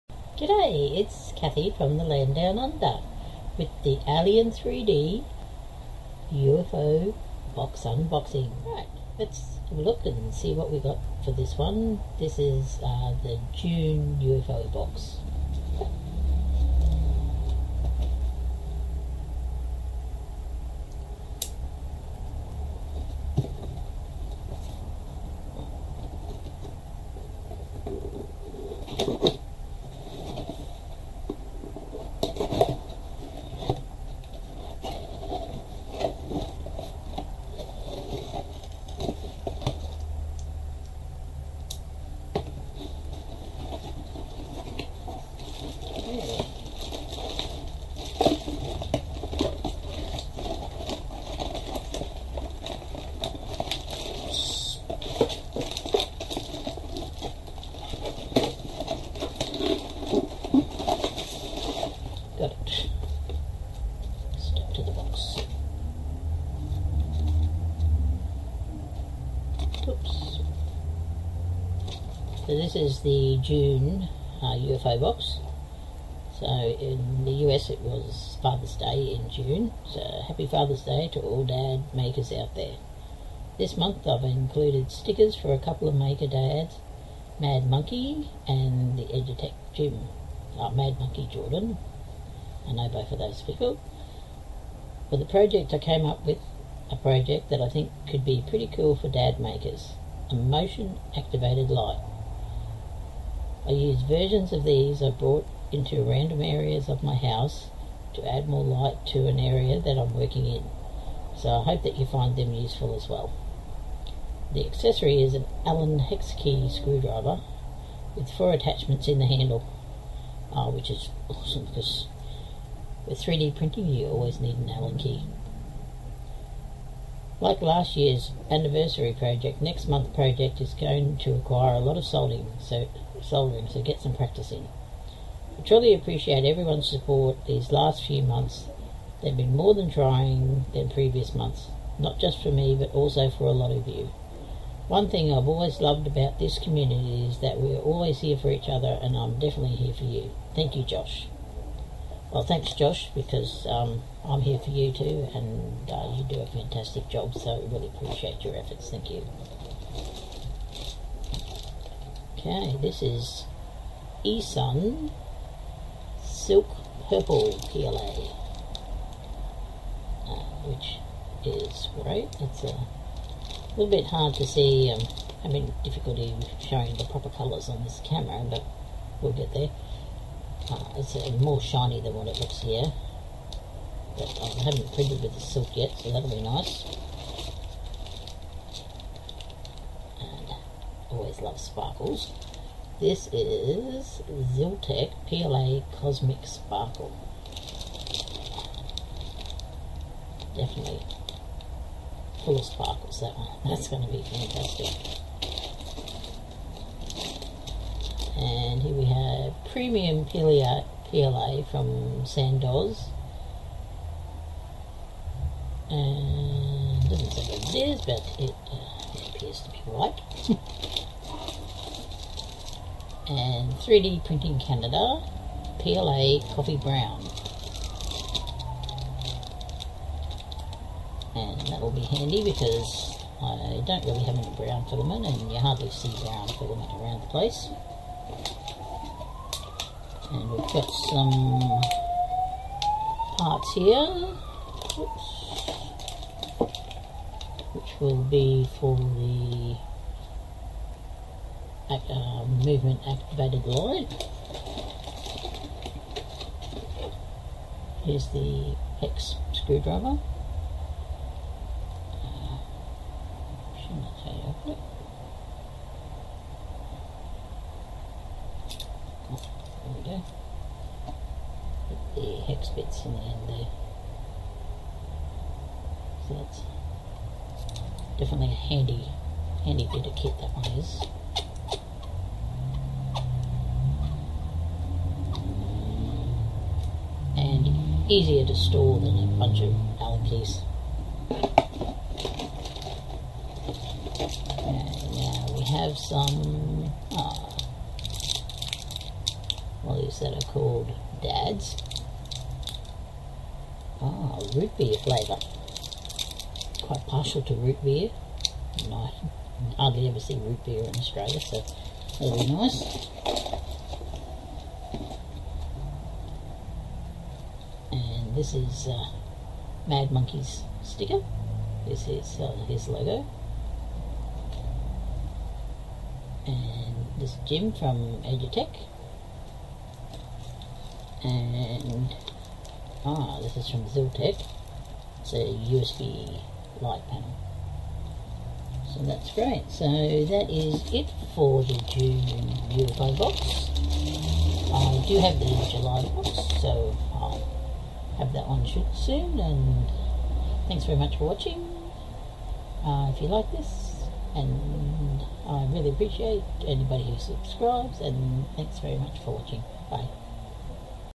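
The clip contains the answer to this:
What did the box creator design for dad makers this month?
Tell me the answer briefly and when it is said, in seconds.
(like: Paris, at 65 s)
A motion activated light, at 100 s.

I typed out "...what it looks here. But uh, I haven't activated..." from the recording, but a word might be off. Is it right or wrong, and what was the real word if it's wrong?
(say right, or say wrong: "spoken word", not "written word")
wrong: "printed", not "activated".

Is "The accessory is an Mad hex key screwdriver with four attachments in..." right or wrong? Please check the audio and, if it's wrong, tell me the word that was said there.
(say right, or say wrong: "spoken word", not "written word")
wrong: "Allen", not "Mad".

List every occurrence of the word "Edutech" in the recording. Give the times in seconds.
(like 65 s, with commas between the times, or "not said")
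89 s, 328 s.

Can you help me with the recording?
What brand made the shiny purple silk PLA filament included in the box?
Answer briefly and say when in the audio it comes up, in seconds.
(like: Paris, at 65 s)
Esun, at 164 s.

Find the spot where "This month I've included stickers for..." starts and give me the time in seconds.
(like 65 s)
83 s.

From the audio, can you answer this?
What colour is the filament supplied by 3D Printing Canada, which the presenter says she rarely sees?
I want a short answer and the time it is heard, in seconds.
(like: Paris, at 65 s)
Coffee Brown, at 226 s.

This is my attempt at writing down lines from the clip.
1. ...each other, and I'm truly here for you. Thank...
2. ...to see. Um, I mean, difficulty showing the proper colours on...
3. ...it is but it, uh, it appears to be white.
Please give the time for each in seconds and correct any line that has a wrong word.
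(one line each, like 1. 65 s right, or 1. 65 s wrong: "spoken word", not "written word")
1. 148 s wrong: "definitely", not "truly"
2. 174 s right
3. 217 s right.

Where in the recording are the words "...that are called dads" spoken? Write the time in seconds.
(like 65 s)
300 s.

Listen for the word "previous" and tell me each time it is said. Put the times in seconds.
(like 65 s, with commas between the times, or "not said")
140 s.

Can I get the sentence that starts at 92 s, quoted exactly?
I know both of those people.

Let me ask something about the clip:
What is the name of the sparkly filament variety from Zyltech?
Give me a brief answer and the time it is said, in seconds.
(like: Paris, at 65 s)
Cosmic Sparkle, at 195 s.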